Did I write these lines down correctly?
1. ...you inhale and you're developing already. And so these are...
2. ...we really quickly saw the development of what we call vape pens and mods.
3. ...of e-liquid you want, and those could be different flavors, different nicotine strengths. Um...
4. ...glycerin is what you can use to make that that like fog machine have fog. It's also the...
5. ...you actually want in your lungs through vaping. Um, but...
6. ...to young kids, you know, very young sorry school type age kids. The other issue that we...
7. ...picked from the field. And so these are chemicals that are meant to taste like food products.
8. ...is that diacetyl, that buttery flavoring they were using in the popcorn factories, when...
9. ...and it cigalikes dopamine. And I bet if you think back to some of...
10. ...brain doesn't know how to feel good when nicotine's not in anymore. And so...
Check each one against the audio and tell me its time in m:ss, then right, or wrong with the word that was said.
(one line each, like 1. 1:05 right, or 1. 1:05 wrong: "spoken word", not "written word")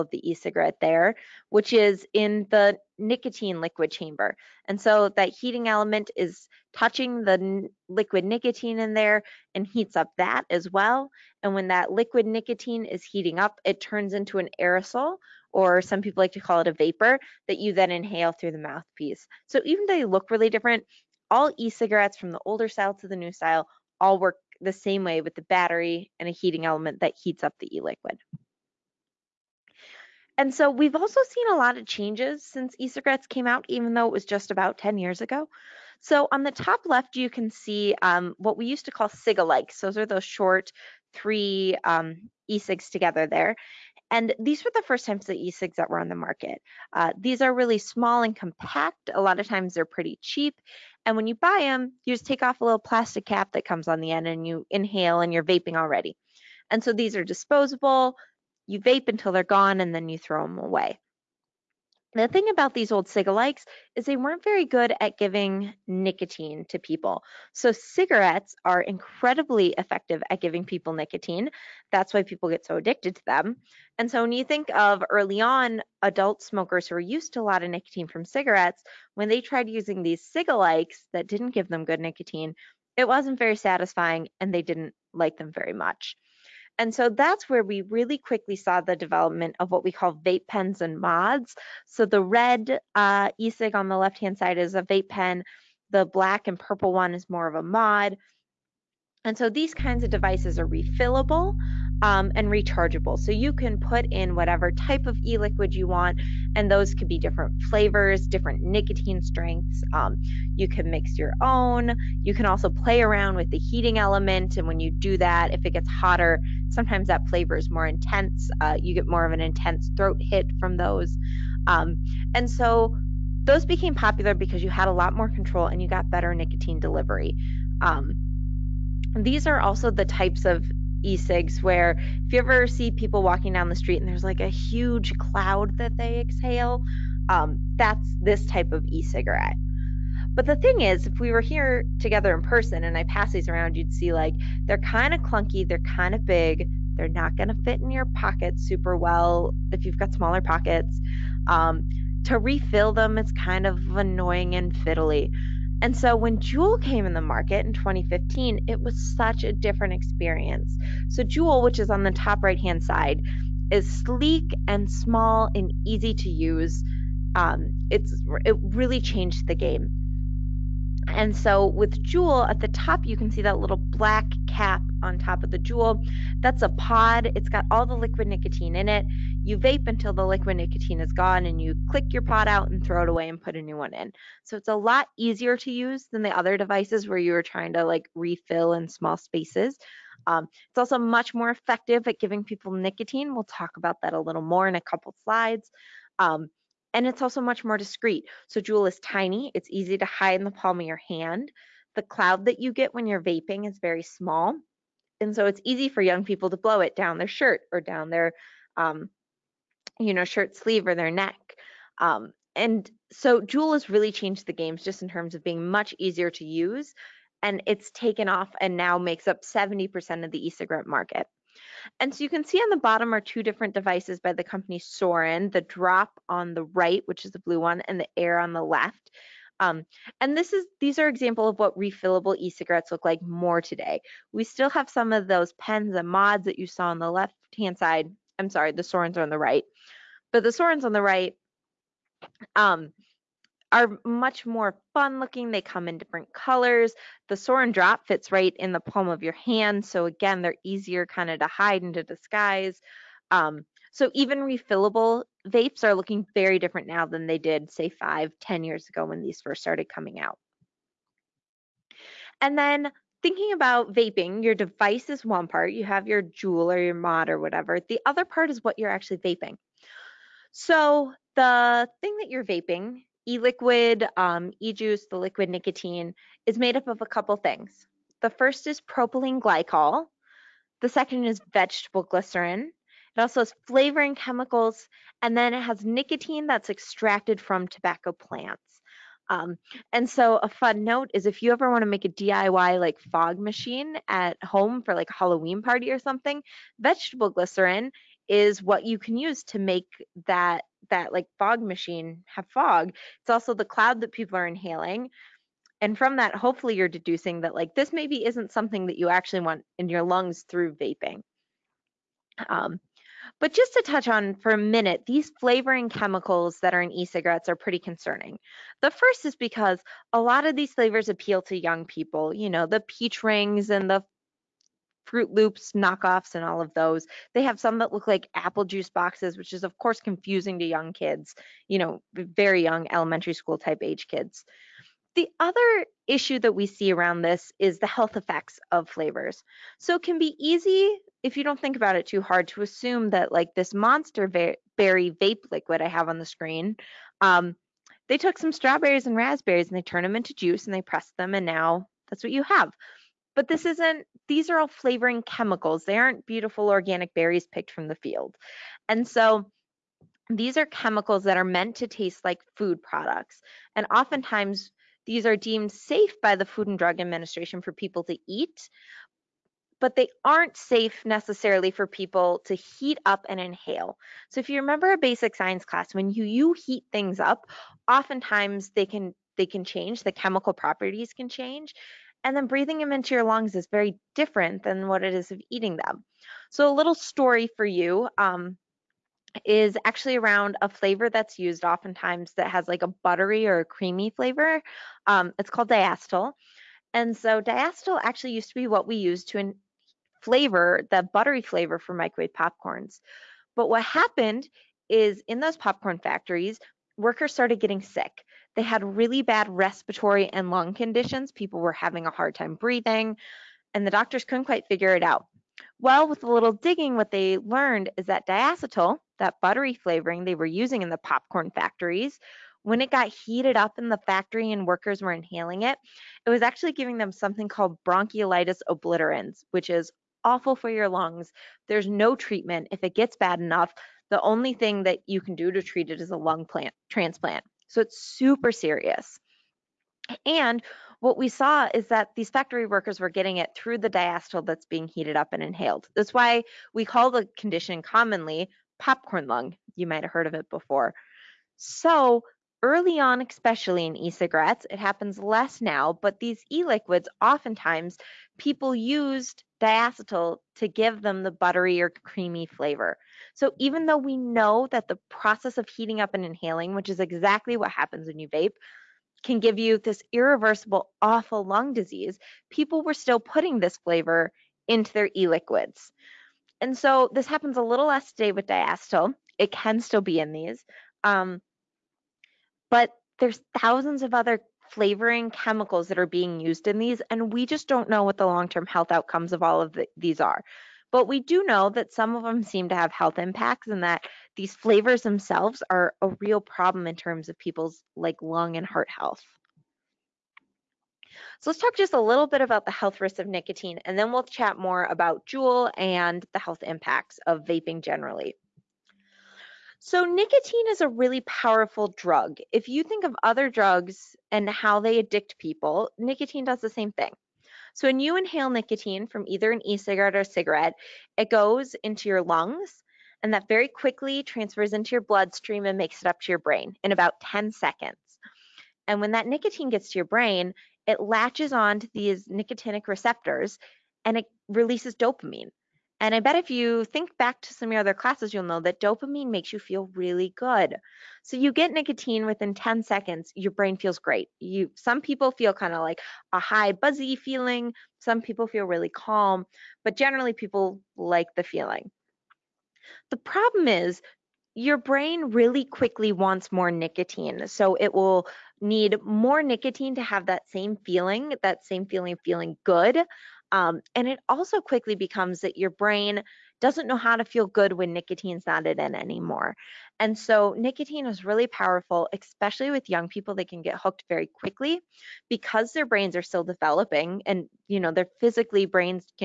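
1. 0:54 wrong: "vaping", not "developing"
2. 1:27 right
3. 1:45 right
4. 4:57 right
5. 5:08 right
6. 5:30 wrong: "elementary", not "sorry"
7. 5:57 right
8. 6:57 right
9. 8:54 wrong: "releases", not "cigalikes"
10. 9:25 right.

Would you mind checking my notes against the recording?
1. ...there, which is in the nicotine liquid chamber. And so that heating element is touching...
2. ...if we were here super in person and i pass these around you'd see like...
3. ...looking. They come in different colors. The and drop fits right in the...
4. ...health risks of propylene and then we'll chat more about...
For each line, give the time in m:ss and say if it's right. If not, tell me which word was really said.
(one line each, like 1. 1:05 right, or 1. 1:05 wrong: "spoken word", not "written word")
1. 0:00 right
2. 2:21 wrong: "together", not "super"
3. 4:05 right
4. 8:22 wrong: "nicotine", not "propylene".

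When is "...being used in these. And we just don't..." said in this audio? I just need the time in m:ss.
8:06.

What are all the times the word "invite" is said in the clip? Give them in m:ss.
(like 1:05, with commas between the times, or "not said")
not said.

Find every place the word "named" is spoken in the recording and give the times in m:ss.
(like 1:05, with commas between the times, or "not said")
not said.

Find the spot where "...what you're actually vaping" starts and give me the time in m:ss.
4:28.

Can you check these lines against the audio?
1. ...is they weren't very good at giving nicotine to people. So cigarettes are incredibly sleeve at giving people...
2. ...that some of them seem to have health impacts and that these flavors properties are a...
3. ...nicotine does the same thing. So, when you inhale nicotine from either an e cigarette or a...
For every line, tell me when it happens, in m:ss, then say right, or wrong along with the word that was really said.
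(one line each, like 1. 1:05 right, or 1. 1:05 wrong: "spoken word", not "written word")
1. 1:03 wrong: "effective", not "sleeve"
2. 8:11 wrong: "themselves", not "properties"
3. 8:35 right.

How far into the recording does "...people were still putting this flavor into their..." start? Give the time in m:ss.
7:52.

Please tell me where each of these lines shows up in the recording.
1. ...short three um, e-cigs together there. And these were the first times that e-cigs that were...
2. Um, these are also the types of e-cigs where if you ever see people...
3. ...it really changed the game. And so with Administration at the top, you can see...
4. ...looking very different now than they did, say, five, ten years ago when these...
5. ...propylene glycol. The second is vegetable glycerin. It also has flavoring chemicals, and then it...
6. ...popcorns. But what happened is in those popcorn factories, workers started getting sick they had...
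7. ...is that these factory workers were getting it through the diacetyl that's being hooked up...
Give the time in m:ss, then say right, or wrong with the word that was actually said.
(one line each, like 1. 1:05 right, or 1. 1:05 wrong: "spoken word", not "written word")
1. 0:40 right
2. 2:07 right
3. 2:48 wrong: "Juul", not "Administration"
4. 4:15 right
5. 4:38 right
6. 6:42 right
7. 7:21 wrong: "heated", not "hooked".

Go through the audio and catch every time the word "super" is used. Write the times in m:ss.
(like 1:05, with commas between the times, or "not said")
2:28, 7:17.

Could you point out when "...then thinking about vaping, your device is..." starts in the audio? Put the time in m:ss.
4:22.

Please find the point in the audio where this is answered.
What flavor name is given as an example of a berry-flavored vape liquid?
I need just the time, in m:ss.
5:43.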